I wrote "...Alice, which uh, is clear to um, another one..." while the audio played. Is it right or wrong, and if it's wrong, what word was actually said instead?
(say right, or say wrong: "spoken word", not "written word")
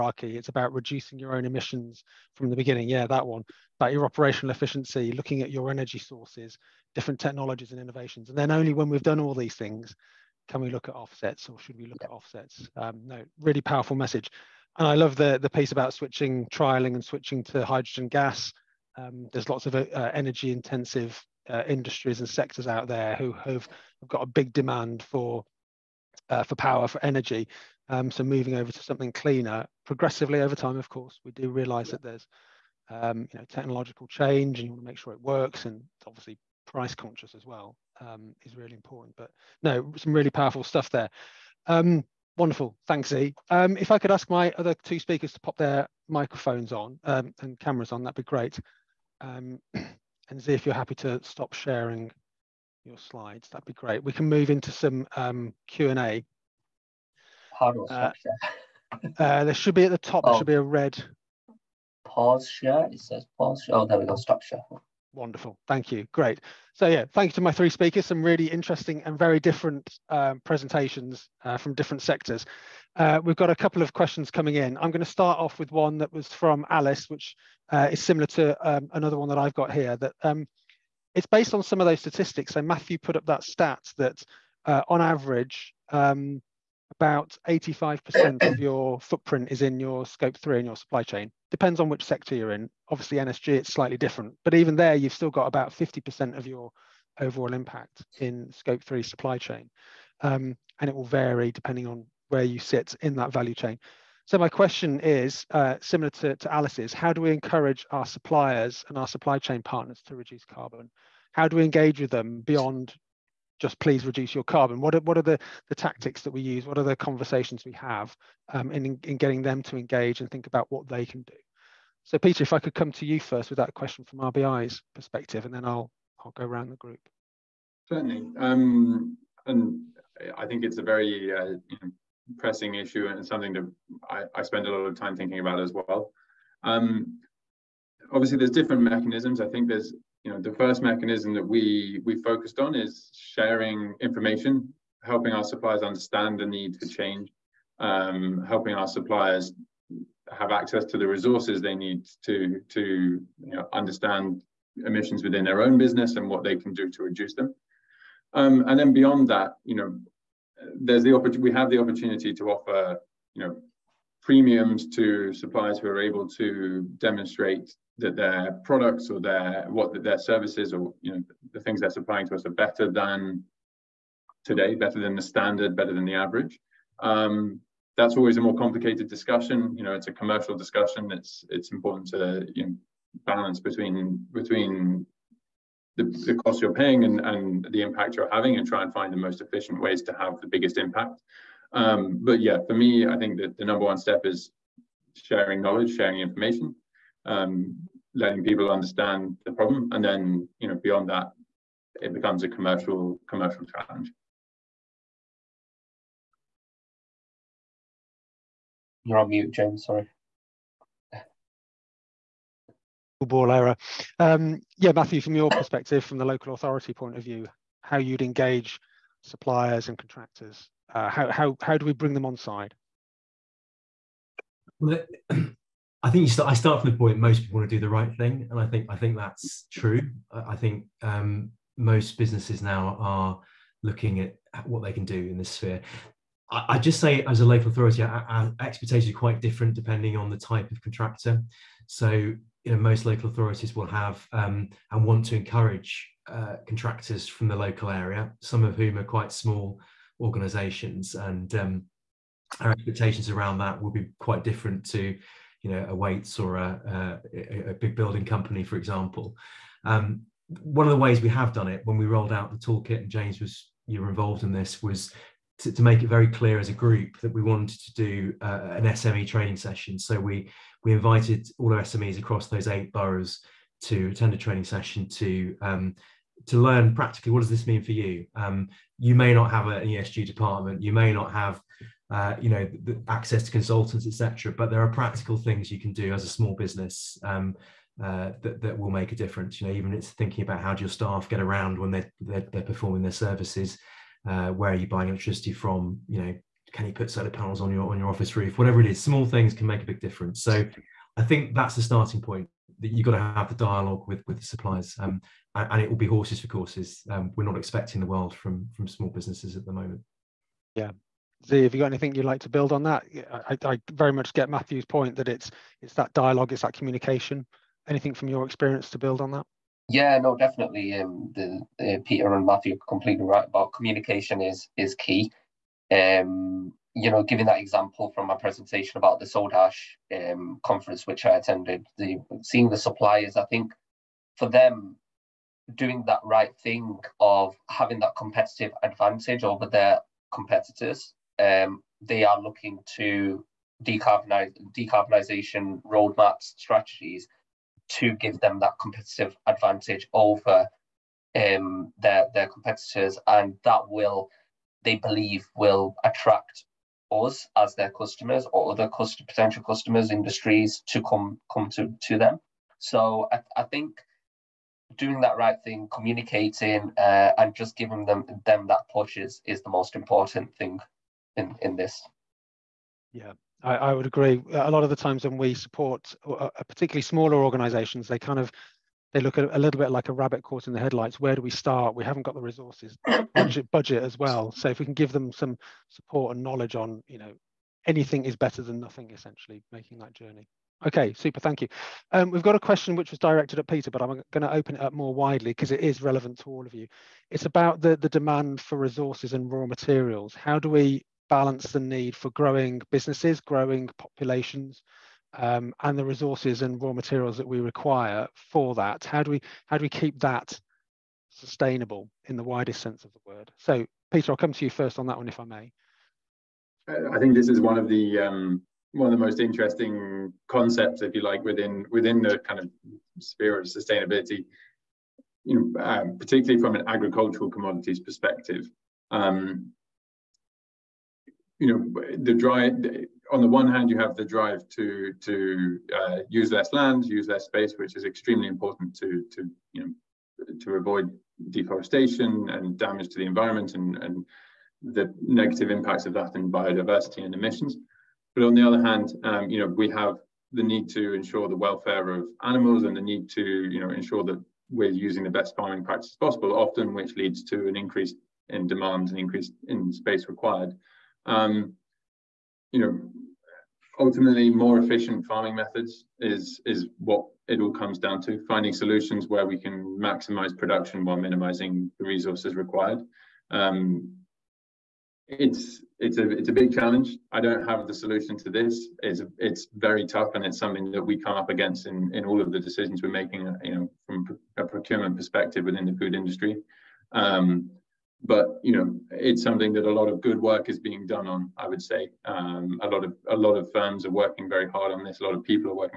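wrong: "similar", not "clear".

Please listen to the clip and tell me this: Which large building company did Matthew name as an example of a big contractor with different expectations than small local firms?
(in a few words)
Wates.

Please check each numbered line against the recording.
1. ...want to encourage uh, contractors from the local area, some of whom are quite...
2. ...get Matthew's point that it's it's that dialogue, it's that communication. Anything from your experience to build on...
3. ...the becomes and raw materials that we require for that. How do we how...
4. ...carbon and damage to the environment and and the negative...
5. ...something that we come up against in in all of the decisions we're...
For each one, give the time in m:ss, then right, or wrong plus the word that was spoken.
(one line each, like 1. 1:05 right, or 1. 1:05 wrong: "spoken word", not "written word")
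1. 4:05 right
2. 5:14 right
3. 6:45 wrong: "resources", not "becomes"
4. 7:21 wrong: "deforestation", not "carbon"
5. 8:00 right.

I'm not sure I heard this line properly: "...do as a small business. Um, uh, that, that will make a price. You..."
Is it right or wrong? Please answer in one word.
wrong.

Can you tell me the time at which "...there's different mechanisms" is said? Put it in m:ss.
2:18.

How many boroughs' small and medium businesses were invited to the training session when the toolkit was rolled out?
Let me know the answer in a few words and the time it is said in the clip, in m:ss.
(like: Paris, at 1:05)
8, at 4:32.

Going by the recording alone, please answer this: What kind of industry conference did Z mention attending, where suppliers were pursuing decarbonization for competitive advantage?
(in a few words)
Soda Ash.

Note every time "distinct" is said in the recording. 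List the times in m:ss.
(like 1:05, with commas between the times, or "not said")
not said.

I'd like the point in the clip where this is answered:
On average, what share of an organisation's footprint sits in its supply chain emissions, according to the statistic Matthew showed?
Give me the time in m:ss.
1:27.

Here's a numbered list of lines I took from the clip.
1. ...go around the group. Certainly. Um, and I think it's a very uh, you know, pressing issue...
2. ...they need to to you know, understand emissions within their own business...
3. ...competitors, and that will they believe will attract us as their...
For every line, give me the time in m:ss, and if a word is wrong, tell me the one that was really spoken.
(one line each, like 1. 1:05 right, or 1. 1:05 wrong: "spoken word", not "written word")
1. 2:06 right
2. 2:31 right
3. 5:52 right.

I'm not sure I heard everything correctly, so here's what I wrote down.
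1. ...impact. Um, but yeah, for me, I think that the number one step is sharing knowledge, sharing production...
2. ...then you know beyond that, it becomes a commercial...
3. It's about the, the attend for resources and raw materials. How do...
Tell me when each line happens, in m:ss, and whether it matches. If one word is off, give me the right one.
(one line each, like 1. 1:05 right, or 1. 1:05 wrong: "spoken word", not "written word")
1. 3:10 wrong: "information", not "production"
2. 3:20 right
3. 6:37 wrong: "demand", not "attend".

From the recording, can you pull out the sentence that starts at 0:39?
But no, some really powerful stuff there.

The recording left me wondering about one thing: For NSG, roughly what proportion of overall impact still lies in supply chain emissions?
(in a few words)
50%.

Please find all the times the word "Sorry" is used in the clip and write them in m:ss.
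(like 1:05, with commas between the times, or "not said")
3:29.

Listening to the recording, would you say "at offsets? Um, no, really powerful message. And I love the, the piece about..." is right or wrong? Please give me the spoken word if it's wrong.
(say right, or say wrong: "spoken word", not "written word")
right.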